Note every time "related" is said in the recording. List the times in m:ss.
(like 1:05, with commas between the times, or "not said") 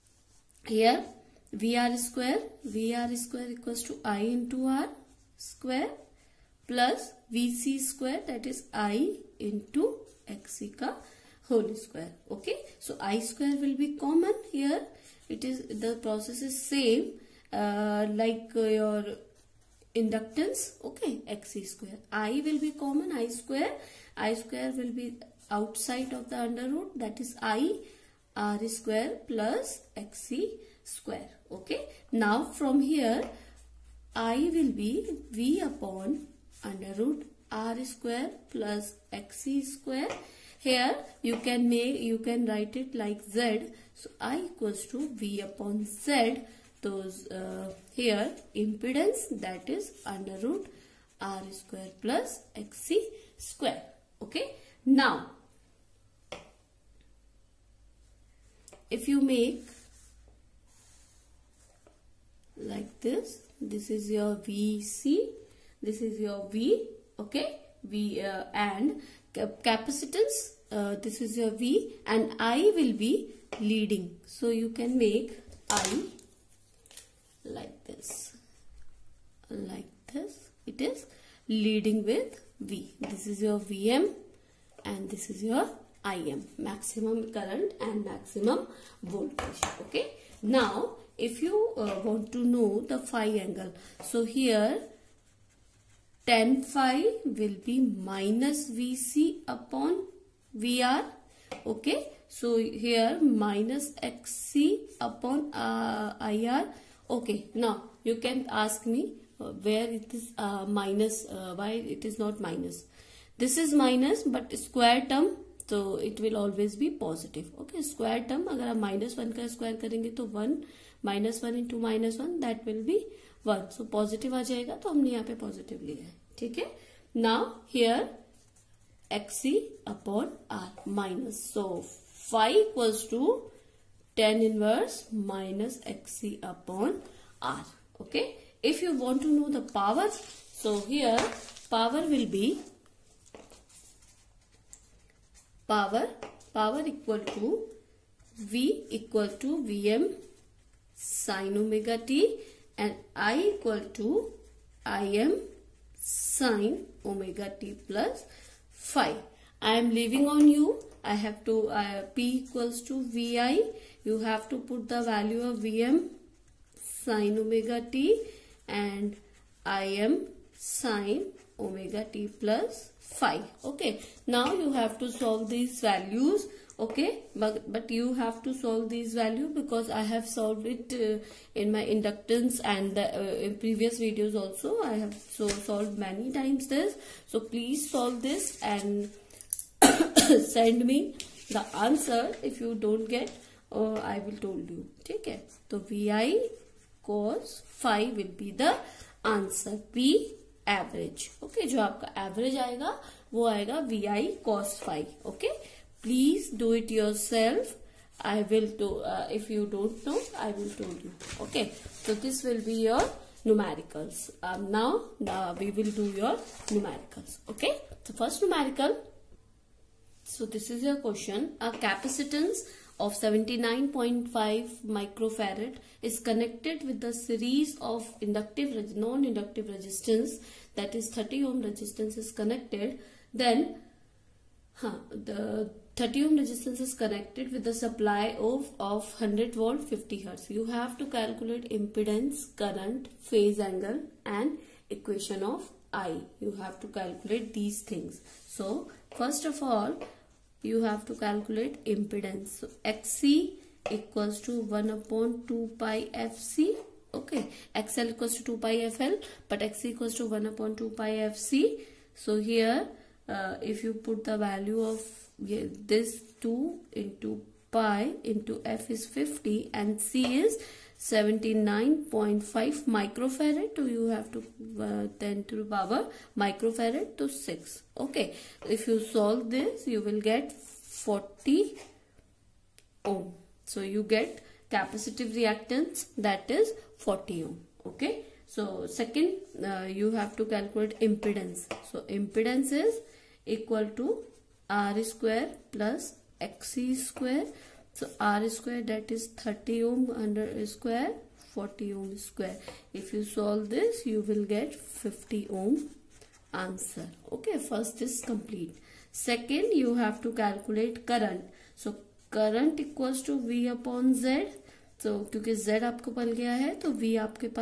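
not said.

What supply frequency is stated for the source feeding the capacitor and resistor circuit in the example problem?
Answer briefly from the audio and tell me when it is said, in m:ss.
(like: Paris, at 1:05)
50 hertz, at 3:59.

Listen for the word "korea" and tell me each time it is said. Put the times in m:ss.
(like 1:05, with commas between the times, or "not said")
not said.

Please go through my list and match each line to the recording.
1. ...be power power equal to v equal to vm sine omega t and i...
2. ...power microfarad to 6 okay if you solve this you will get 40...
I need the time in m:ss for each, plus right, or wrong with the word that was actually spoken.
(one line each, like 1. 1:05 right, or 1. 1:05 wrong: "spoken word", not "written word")
1. 2:22 right
2. 4:35 right.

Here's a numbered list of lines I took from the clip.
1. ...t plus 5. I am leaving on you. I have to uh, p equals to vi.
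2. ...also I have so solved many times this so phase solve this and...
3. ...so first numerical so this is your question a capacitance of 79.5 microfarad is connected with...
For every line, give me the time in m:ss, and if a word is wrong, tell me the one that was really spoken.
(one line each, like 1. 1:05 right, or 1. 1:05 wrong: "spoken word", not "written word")
1. 2:37 right
2. 3:04 wrong: "please", not "phase"
3. 3:38 right.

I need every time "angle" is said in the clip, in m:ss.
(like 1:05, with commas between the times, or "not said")
1:33, 4:03.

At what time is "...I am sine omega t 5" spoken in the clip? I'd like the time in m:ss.
2:49.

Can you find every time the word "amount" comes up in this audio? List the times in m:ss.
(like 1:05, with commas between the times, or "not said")
not said.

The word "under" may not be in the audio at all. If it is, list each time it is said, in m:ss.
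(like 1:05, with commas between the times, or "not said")
0:26, 0:36, 0:50.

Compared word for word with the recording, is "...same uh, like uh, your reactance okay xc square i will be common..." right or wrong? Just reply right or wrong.
wrong.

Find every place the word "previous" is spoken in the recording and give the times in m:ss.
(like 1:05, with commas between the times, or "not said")
3:03.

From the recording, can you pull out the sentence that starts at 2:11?
So phi equals to tan inverse minus xc upon r.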